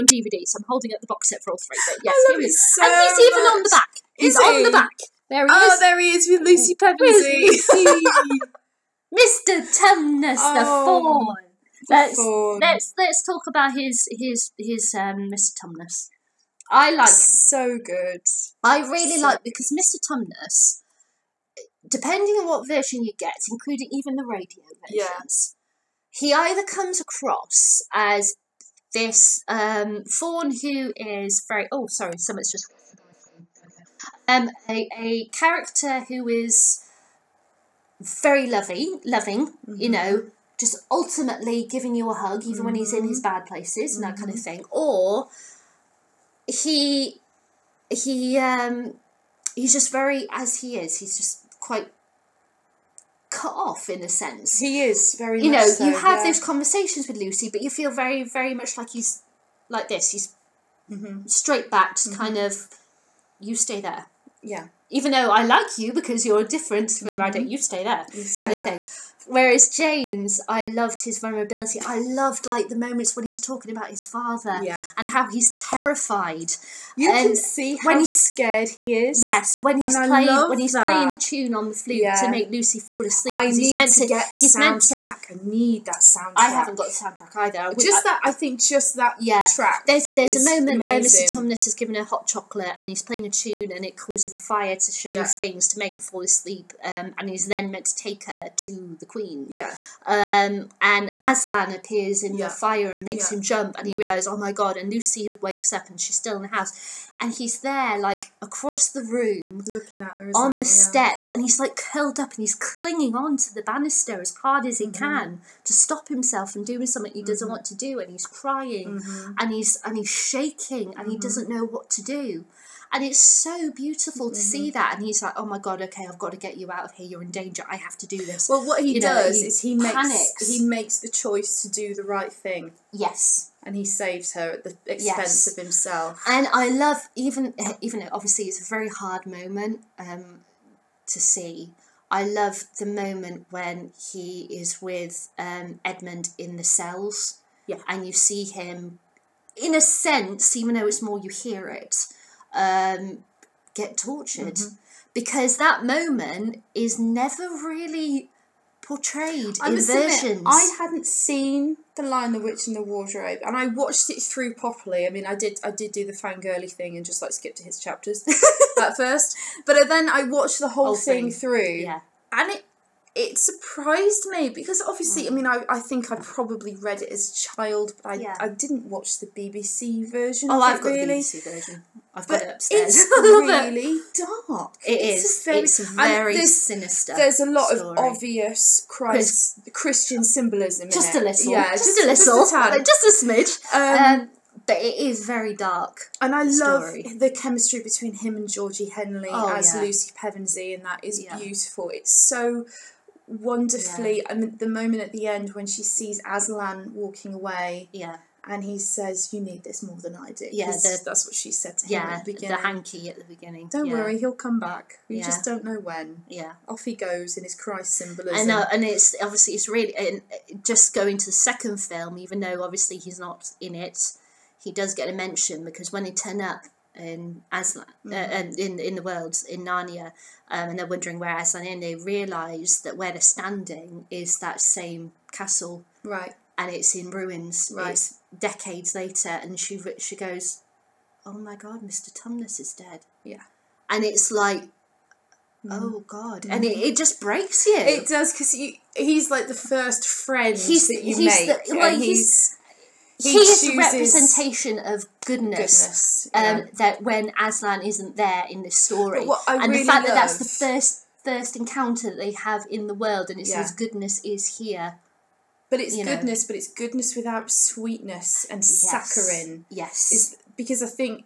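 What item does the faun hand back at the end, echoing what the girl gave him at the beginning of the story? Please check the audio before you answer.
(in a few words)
hanky.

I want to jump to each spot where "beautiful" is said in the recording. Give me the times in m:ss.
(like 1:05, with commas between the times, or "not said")
2:03, 3:21.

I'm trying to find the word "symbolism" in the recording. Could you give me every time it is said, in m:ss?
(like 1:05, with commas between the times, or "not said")
3:10, 3:37.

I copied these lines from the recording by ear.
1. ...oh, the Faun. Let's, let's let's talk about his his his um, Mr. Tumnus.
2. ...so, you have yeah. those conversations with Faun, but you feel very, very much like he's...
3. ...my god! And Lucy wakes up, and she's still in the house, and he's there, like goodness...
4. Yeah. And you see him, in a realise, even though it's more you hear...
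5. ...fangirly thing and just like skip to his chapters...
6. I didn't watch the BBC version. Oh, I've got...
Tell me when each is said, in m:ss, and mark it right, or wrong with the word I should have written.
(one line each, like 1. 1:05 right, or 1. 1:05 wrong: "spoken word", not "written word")
1. 0:10 right
2. 0:55 wrong: "Lucy", not "Faun"
3. 1:44 wrong: "across", not "goodness"
4. 2:27 wrong: "sense", not "realise"
5. 2:46 right
6. 2:58 right.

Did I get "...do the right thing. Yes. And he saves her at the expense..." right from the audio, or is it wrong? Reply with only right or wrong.
right.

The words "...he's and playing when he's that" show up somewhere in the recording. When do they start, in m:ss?
1:19.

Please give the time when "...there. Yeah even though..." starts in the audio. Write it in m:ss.
1:03.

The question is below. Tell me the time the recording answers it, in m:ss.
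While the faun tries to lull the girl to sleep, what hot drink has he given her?
1:32.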